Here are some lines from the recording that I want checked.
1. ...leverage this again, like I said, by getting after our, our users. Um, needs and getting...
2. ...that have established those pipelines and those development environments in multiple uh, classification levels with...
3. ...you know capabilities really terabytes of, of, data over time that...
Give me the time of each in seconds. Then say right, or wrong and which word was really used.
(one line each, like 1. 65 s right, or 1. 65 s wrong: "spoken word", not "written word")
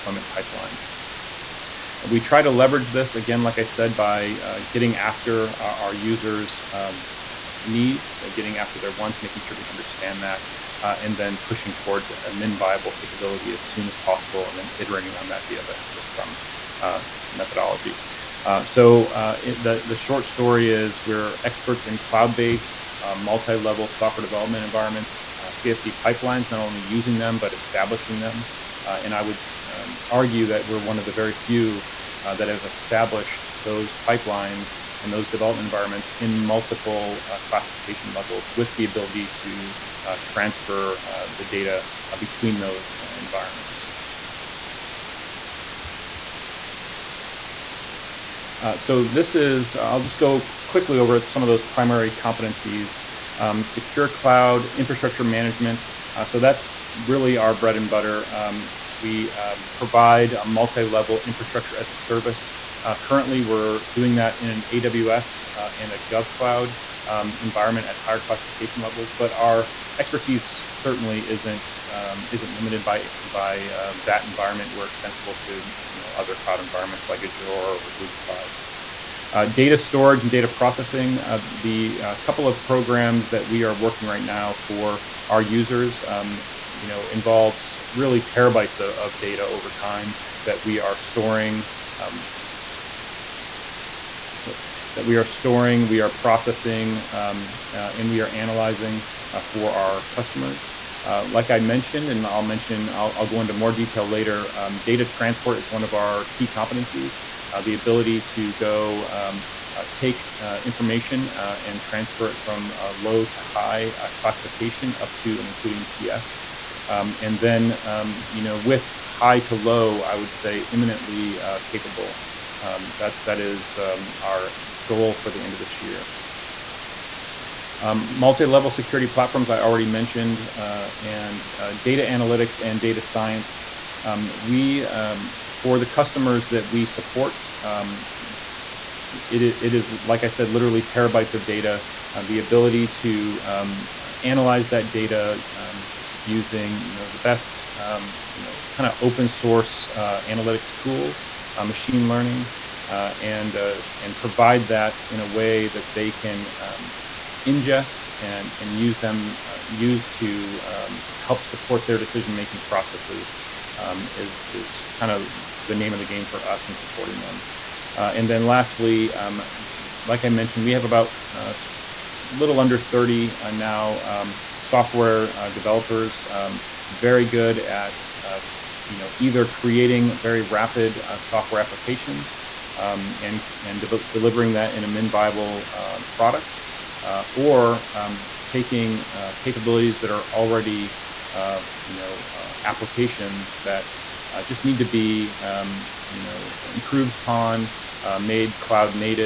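1. 2 s right
2. 32 s right
3. 86 s wrong: "involves", not "capabilities".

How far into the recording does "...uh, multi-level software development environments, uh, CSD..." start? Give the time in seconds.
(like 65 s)
23 s.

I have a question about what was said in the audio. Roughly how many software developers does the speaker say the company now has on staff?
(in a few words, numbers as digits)
under 30.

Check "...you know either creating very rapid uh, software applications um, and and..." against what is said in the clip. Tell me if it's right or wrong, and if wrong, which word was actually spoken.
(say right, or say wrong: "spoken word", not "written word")
right.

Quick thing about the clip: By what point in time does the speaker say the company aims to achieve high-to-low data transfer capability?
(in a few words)
end of this year.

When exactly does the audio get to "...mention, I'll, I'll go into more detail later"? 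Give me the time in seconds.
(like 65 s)
102 s.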